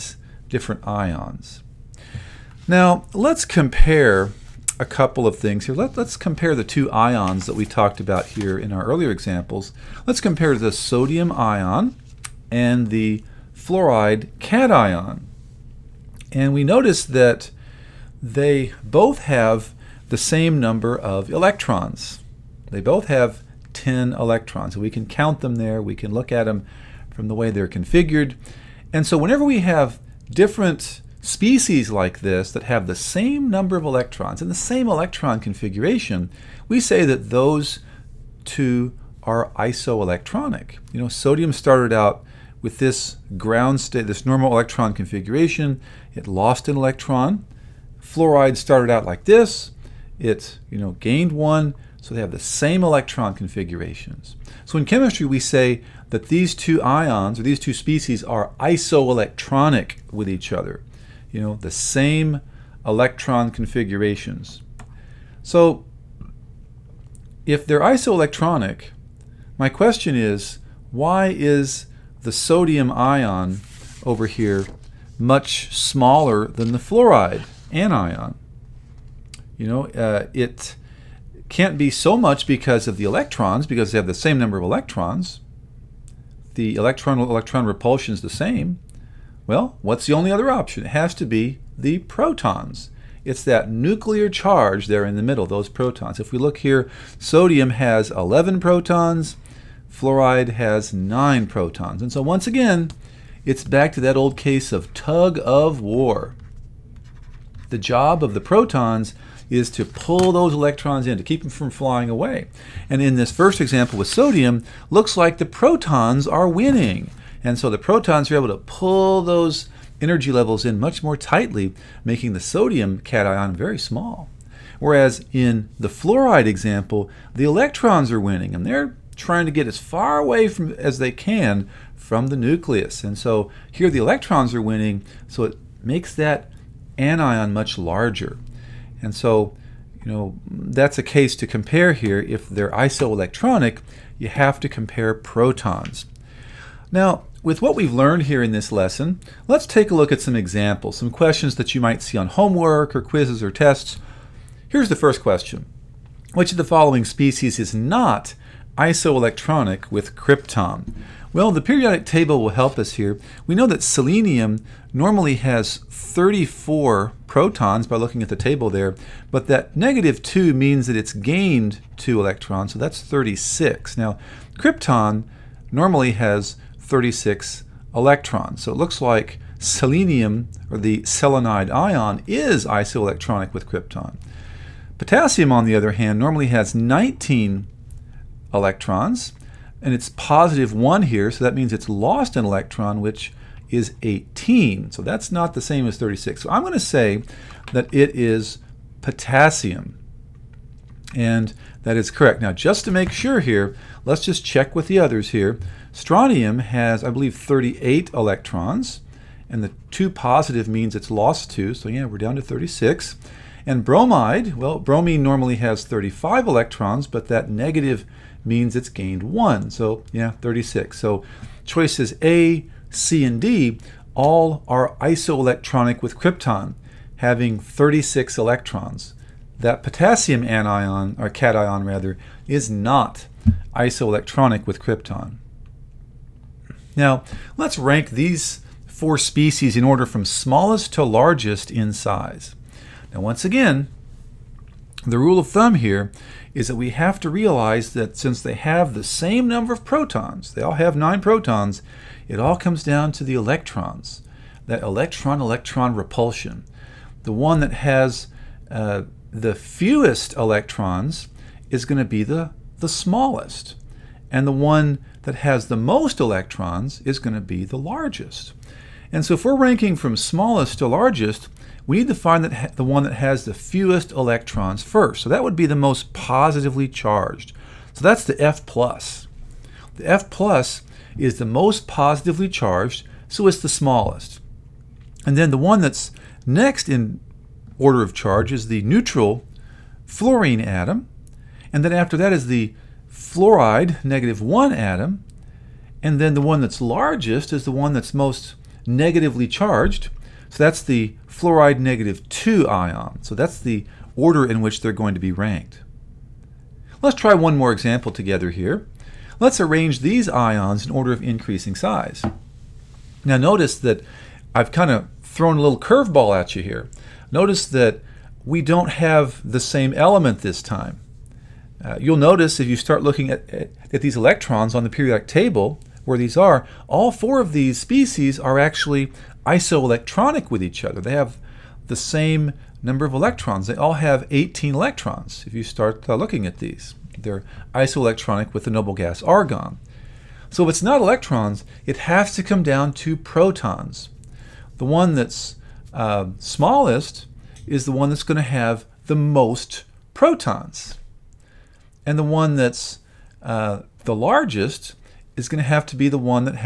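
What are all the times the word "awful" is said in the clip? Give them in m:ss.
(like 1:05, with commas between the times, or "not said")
not said.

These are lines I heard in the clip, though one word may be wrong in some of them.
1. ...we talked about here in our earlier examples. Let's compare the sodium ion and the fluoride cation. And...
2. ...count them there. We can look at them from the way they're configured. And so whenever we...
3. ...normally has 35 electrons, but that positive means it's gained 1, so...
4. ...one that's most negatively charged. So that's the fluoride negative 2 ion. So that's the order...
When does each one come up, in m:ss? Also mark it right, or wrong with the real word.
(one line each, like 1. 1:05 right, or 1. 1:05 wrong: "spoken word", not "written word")
1. 0:07 right
2. 0:25 right
3. 3:35 wrong: "negative", not "positive"
4. 4:57 right.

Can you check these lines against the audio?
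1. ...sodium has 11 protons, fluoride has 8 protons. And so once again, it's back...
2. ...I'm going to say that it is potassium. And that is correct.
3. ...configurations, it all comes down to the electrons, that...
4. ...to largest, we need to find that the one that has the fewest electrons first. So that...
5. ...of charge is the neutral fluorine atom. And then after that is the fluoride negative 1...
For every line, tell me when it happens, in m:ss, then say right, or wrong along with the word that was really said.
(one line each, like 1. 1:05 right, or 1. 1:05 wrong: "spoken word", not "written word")
1. 1:37 wrong: "9", not "8"
2. 3:16 right
3. 4:11 wrong: "protons", not "configurations"
4. 4:30 right
5. 4:48 right.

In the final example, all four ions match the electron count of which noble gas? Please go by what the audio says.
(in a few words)
Argon.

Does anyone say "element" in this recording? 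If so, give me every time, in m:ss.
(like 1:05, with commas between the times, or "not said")
5:19.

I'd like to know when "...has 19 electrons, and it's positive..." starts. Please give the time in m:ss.
3:06.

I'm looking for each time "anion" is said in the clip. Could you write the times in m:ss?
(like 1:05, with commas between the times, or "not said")
1:17, 2:16, 3:50.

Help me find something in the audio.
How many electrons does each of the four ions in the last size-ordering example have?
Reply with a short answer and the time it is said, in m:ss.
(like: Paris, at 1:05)
18, at 5:34.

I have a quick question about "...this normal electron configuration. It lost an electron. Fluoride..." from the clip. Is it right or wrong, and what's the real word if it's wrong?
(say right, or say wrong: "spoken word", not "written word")
right.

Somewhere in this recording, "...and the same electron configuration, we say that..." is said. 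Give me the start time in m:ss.
0:34.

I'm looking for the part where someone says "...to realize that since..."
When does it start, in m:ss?
4:07.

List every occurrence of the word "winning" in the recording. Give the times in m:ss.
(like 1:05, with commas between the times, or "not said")
1:56, 2:08, 2:14.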